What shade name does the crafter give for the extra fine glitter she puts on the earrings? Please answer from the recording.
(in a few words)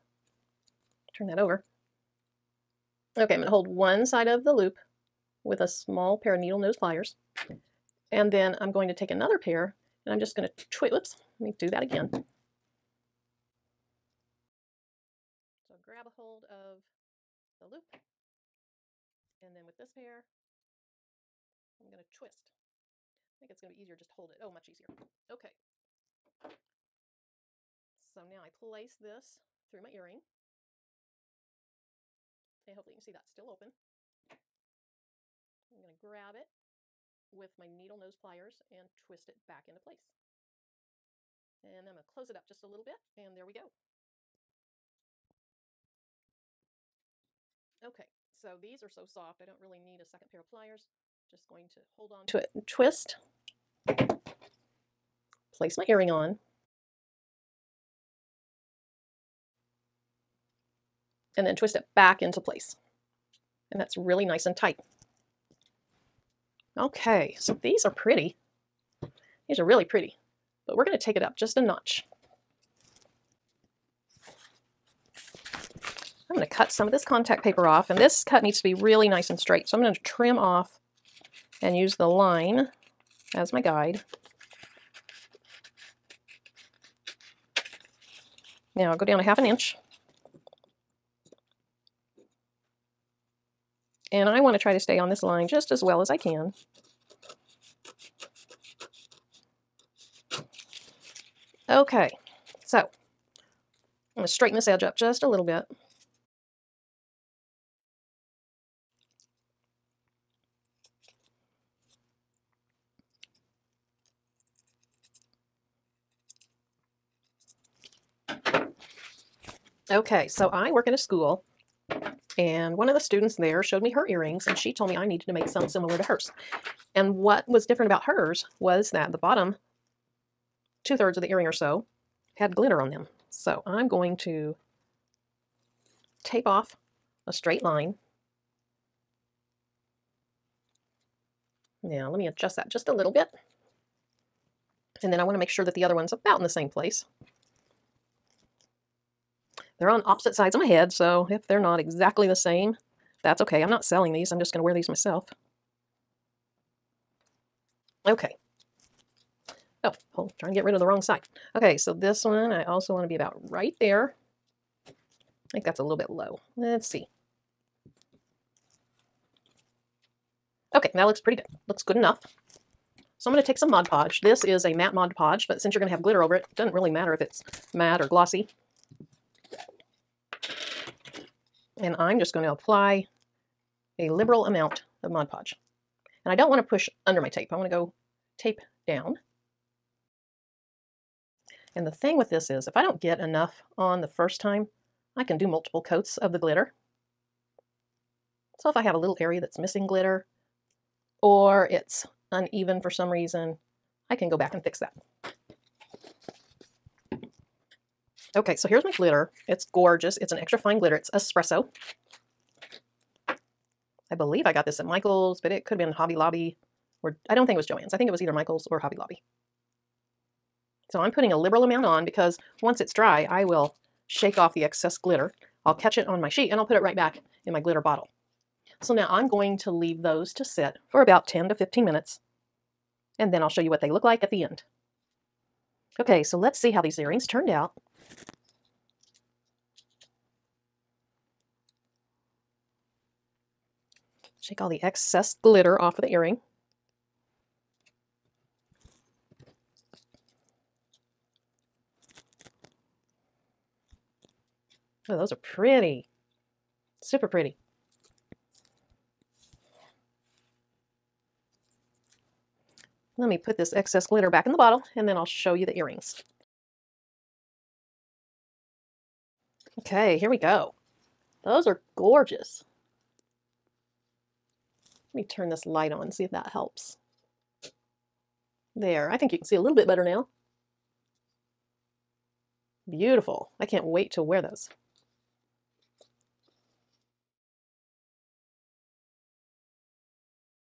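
espresso.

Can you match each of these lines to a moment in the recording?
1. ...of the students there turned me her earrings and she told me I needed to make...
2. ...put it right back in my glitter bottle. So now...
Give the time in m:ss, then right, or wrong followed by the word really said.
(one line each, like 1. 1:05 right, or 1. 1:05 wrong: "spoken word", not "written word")
1. 2:02 wrong: "showed", not "turned"
2. 3:46 right.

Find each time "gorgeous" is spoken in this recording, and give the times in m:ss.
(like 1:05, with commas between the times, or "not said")
3:29, 4:31.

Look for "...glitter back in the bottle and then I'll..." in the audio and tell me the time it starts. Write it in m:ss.
4:24.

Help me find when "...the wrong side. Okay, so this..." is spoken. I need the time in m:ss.
2:40.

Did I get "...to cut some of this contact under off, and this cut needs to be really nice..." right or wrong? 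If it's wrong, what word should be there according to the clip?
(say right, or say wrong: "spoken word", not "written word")
wrong: "paper", not "under".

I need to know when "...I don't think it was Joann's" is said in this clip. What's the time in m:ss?
3:37.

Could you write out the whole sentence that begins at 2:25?
And then I want to make sure that the other one's about in the same place.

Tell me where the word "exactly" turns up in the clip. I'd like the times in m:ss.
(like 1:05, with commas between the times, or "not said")
2:31.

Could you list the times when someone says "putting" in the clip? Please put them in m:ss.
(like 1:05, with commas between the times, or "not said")
3:41.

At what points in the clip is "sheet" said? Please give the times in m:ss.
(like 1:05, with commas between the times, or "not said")
3:46.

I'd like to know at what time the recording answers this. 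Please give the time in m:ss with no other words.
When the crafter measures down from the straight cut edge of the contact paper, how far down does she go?
1:29.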